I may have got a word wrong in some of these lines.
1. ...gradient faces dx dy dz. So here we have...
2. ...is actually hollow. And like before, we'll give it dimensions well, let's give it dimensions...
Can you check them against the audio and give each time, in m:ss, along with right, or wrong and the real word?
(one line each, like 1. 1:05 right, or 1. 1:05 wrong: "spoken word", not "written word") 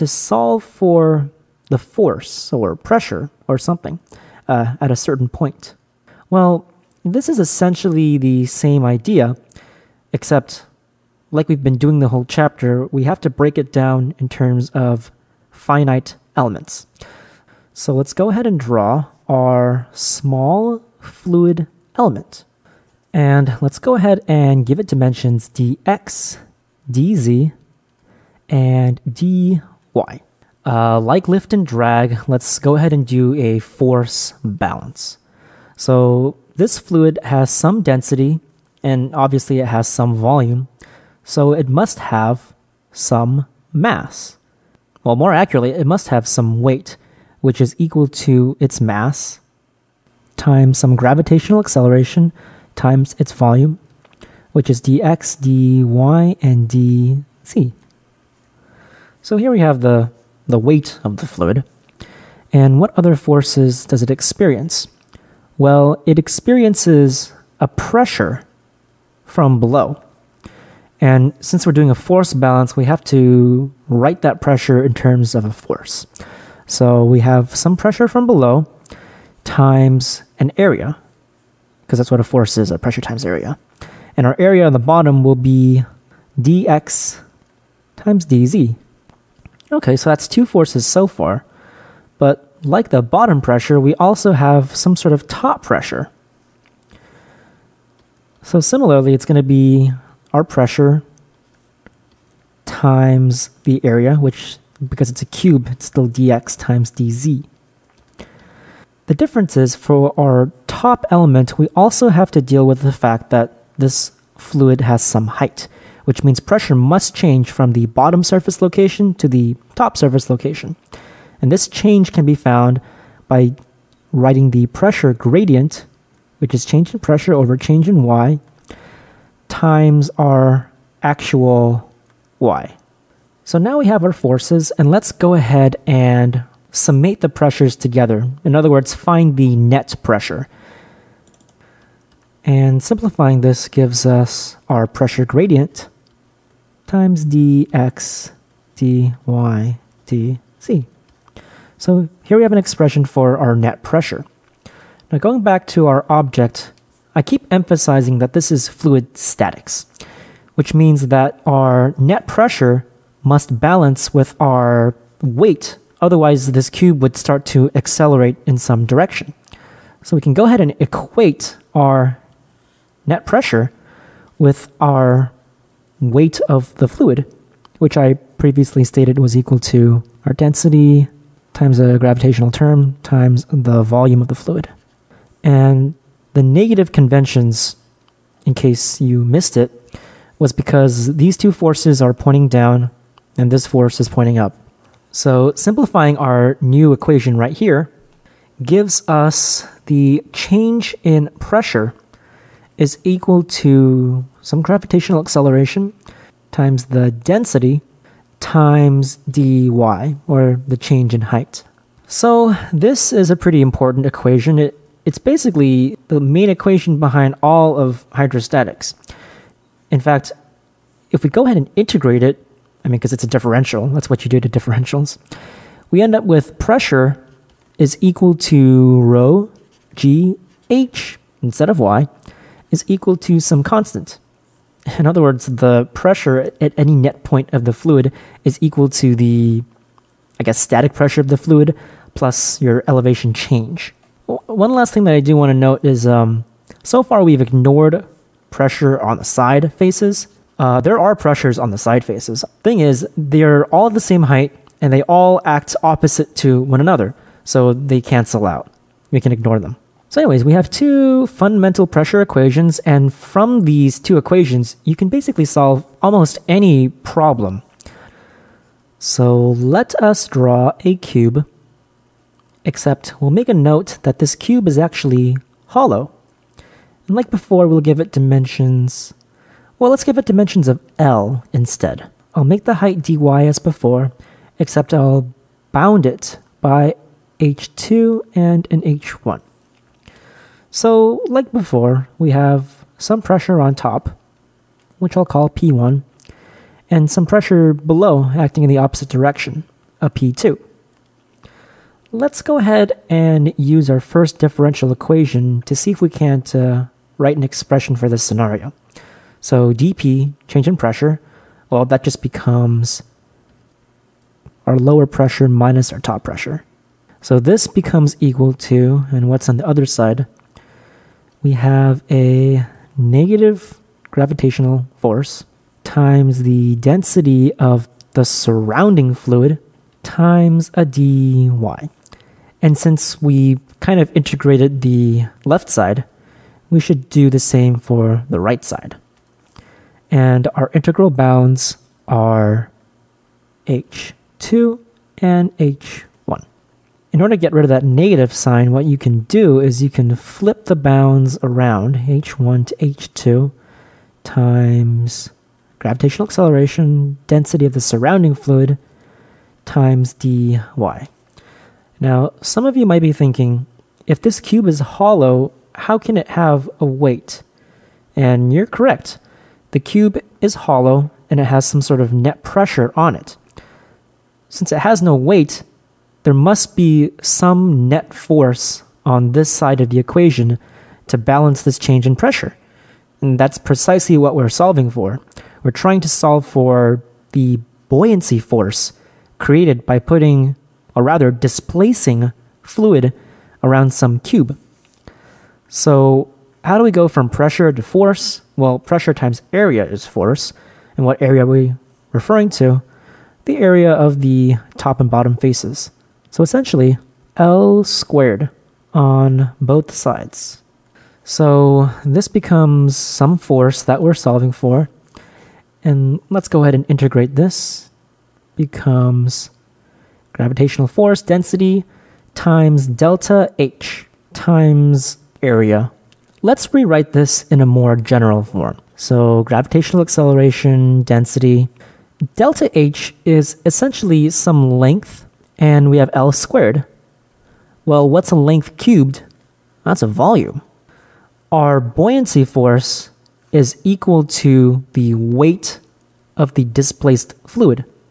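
1. 2:25 wrong: "times", not "faces"
2. 4:34 right.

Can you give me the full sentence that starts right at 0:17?
So let's go ahead and draw our small fluid element.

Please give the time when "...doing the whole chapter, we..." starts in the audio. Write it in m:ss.
0:11.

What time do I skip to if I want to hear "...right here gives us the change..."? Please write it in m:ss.
3:17.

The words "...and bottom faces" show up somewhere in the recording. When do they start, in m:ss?
6:44.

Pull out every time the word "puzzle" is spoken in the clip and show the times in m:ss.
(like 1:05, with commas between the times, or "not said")
not said.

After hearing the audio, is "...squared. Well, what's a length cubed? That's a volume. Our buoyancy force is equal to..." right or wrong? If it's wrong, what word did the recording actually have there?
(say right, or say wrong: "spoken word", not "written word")
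right.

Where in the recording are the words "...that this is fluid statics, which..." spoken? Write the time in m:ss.
2:38.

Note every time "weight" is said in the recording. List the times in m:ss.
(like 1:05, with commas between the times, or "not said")
0:46, 1:00, 2:45, 2:55, 6:06, 6:15, 7:25.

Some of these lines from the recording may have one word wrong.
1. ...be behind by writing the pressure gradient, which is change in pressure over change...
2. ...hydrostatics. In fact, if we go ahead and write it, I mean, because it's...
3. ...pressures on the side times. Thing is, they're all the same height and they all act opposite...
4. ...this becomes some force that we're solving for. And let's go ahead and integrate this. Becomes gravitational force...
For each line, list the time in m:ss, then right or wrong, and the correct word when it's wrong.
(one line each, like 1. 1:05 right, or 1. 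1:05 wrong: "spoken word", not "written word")
1. 2:02 wrong: "found", not "behind"
2. 3:38 wrong: "integrate", not "write"
3. 4:11 wrong: "faces", not "times"
4. 6:52 right.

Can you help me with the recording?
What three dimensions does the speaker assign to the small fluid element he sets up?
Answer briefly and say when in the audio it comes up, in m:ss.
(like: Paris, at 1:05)
dx, dz, and dy, at 0:25.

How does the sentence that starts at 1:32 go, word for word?
But like the bottom pressure, we also have some sort of top pressure.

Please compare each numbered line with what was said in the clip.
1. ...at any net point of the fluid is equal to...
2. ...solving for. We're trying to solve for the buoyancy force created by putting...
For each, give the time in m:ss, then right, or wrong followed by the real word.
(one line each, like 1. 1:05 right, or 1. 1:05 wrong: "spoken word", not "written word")
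1. 3:56 right
2. 6:24 right.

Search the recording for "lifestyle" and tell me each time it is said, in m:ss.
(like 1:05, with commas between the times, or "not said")
not said.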